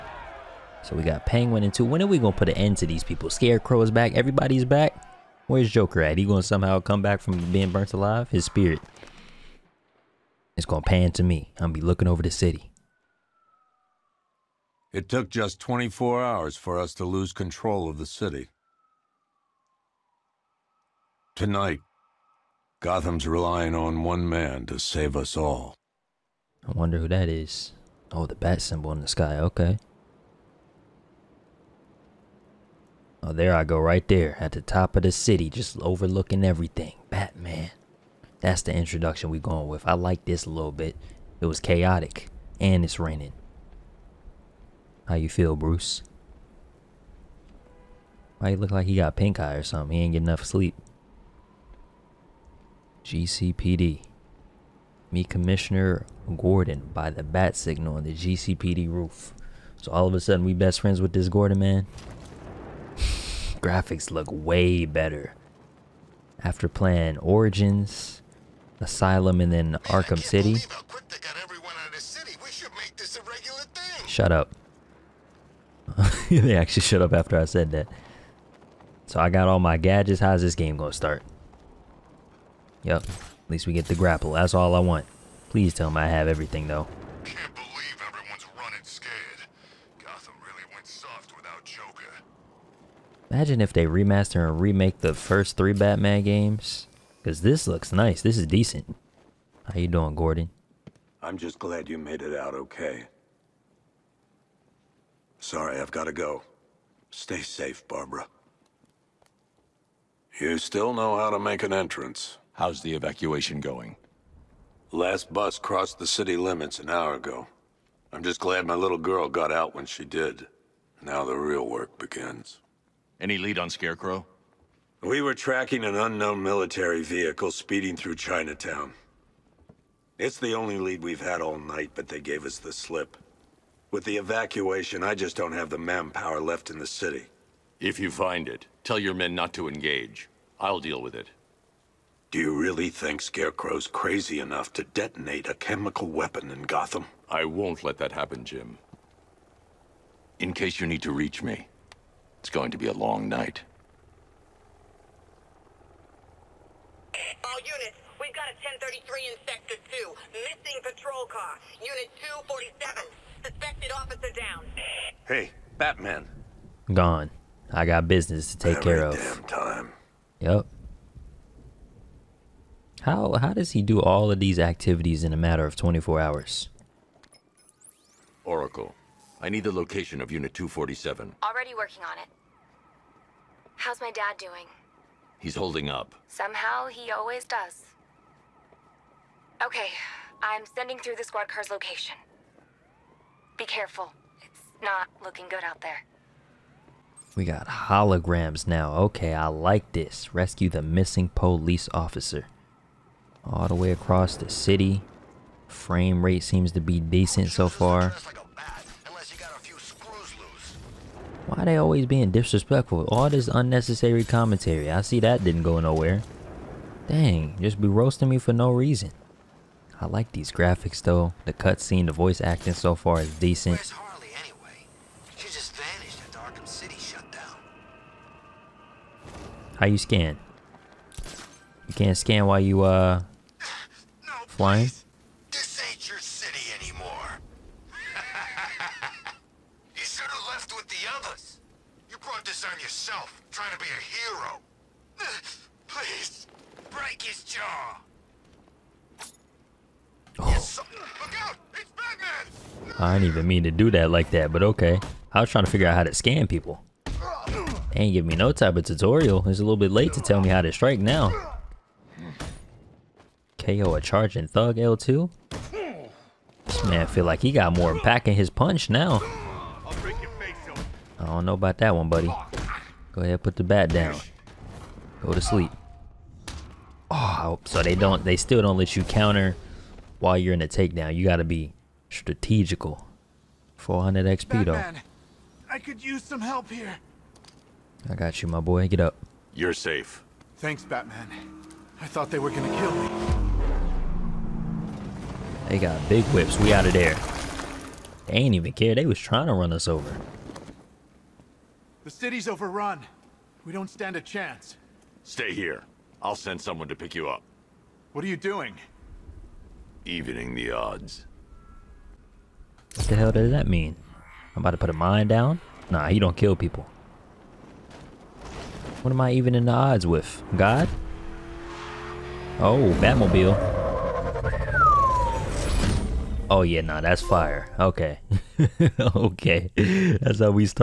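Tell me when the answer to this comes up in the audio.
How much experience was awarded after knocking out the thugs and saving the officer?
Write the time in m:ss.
4:43.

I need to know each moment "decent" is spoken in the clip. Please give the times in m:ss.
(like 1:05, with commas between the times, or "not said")
1:38, 3:27, 3:43.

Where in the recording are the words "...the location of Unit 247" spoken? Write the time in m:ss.
2:59.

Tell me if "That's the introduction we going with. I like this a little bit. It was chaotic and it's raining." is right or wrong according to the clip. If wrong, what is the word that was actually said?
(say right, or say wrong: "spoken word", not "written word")
right.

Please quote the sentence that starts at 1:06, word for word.
After playing Origins, Asylum, and then Arkham City.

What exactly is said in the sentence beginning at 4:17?
They ain't give me no type of tutorial.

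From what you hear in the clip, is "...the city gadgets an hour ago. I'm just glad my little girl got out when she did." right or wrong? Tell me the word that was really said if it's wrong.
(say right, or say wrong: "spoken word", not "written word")
wrong: "limits", not "gadgets".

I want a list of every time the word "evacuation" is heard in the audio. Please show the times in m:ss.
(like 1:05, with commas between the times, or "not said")
1:52, 2:14.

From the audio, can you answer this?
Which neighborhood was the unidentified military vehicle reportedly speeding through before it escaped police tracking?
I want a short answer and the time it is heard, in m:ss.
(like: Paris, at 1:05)
Chinatown, at 2:08.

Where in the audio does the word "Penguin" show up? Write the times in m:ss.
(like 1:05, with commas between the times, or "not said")
0:01.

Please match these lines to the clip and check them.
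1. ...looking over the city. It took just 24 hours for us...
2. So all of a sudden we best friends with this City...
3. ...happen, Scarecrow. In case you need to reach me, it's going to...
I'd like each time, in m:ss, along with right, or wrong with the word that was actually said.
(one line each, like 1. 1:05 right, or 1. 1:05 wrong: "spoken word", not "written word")
1. 0:11 right
2. 0:59 wrong: "Gordon", not "City"
3. 2:28 wrong: "Jim", not "Scarecrow".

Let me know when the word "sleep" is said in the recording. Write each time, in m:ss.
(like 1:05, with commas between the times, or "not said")
0:50, 4:35.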